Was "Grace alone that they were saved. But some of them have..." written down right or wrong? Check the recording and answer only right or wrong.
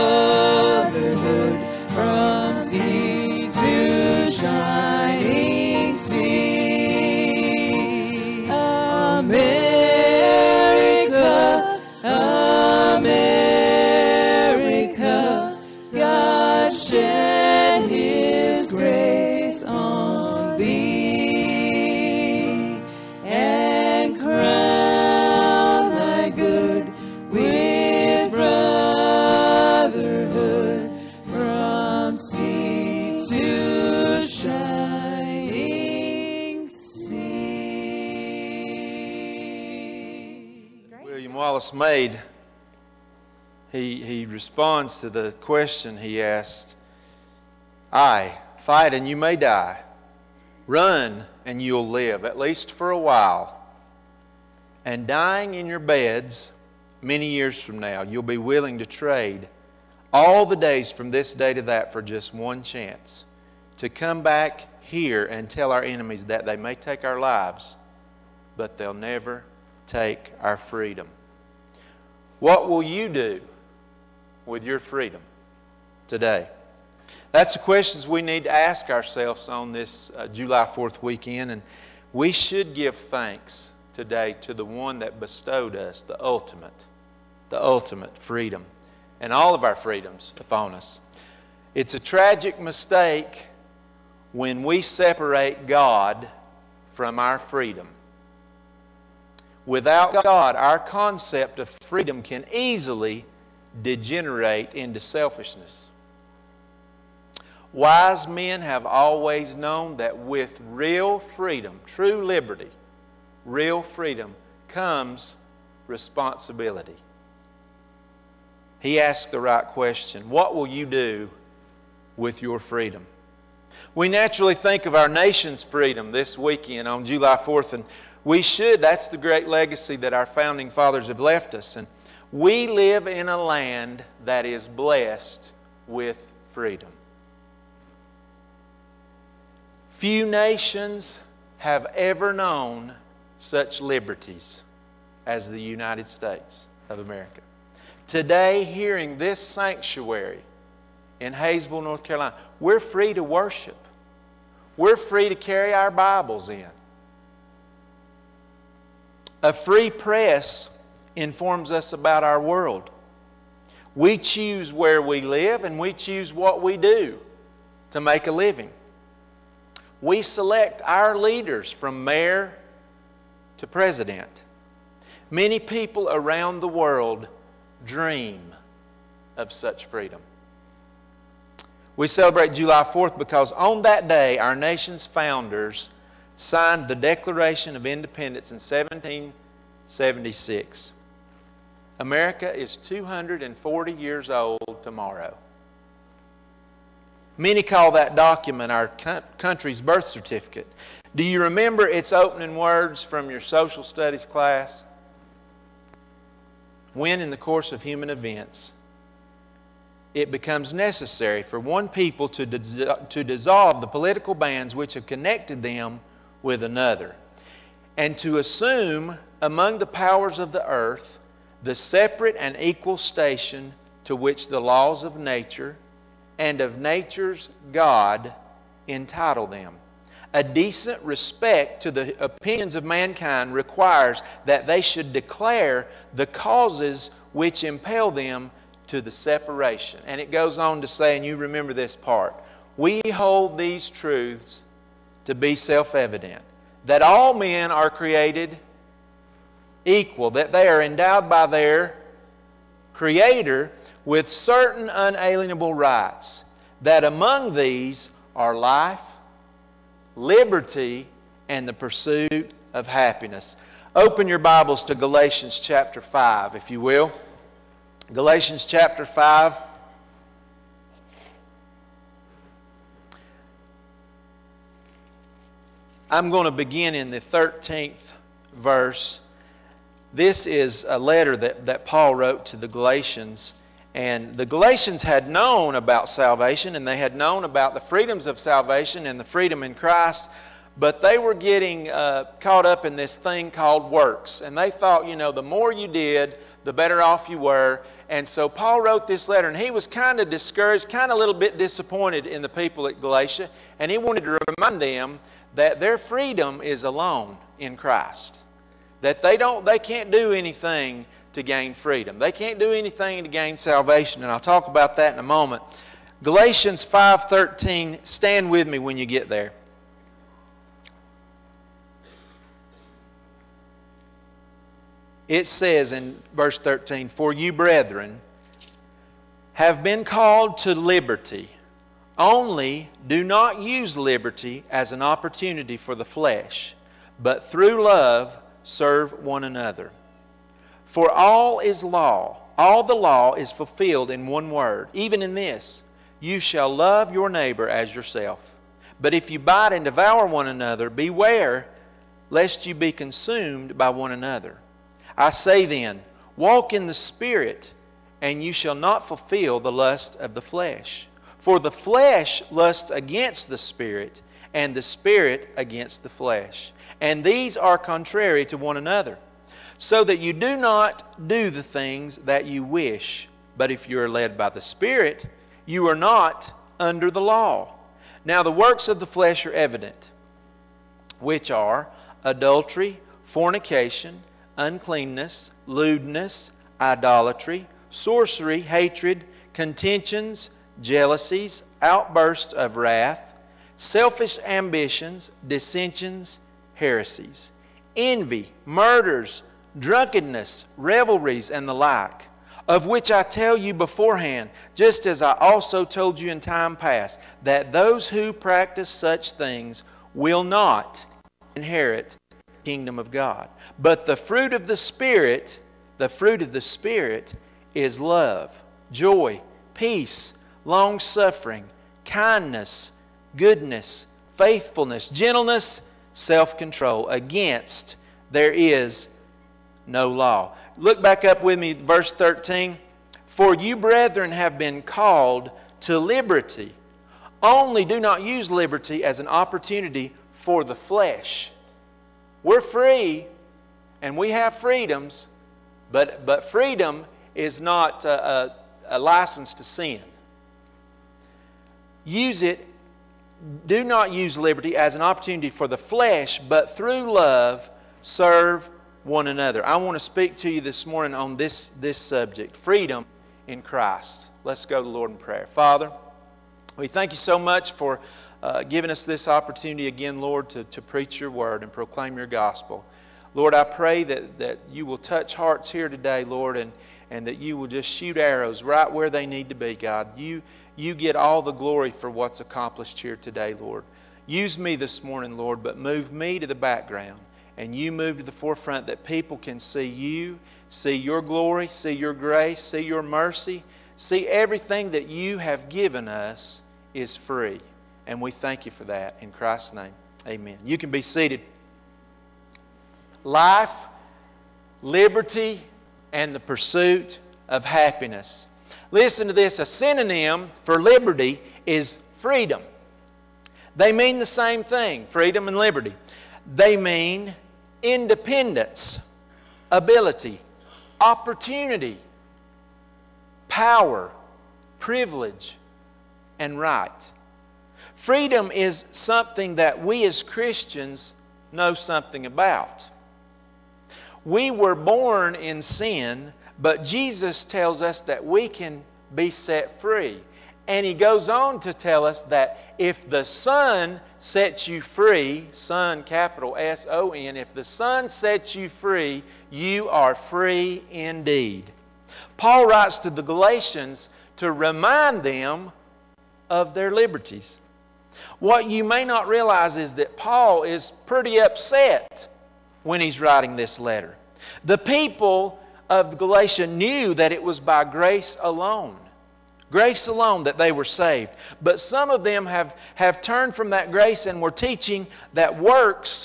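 right.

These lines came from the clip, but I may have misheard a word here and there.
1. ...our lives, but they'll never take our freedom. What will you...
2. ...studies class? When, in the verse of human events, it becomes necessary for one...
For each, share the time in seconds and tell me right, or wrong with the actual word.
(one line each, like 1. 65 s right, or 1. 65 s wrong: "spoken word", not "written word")
1. 67 s right
2. 203 s wrong: "course", not "verse".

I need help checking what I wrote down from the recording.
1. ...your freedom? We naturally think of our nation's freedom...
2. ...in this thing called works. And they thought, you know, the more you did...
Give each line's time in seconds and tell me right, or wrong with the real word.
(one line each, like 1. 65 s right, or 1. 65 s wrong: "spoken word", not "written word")
1. 122 s right
2. 292 s right.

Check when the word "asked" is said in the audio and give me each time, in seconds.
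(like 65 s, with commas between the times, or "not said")
46 s, 118 s.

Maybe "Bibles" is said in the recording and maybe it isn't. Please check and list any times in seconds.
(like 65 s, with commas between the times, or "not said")
155 s, 264 s.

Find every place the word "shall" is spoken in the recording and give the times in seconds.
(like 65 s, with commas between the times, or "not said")
346 s, 358 s.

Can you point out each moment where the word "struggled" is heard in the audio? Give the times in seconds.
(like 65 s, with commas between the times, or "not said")
not said.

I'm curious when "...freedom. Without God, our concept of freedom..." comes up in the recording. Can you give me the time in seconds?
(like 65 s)
97 s.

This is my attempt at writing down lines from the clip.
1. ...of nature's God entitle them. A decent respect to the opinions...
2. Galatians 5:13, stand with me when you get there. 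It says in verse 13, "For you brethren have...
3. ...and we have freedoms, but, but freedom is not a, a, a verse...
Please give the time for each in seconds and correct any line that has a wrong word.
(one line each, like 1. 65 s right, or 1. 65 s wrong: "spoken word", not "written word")
1. 226 s right
2. 316 s right
3. 444 s wrong: "license", not "verse".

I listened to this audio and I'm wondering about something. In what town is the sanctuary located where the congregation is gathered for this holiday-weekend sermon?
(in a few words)
Hayesville, North Carolina.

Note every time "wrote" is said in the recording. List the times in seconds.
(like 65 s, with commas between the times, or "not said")
282 s, 298 s.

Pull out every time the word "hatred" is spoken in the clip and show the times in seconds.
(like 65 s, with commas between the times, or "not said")
388 s.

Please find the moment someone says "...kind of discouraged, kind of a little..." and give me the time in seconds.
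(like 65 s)
299 s.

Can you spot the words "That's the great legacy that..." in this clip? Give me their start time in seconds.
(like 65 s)
128 s.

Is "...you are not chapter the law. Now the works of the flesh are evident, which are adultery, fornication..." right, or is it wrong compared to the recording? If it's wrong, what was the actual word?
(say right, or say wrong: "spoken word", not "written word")
wrong: "under", not "chapter".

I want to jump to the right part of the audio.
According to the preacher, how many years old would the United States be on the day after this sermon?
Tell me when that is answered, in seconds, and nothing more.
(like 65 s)
192 s.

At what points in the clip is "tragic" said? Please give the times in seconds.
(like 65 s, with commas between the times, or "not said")
92 s.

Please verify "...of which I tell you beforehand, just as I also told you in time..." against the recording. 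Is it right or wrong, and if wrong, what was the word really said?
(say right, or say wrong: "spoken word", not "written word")
right.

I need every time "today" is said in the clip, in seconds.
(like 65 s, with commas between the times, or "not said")
76 s, 83 s, 148 s, 475 s, 483 s.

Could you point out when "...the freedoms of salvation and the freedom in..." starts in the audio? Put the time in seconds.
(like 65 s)
287 s.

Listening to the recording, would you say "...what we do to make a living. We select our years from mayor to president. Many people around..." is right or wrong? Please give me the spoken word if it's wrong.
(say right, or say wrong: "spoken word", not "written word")
wrong: "leaders", not "years".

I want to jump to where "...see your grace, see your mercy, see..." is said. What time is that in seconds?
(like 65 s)
491 s.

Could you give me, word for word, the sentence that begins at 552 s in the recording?
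Paul writes to the Galatians to remind them of their liberties.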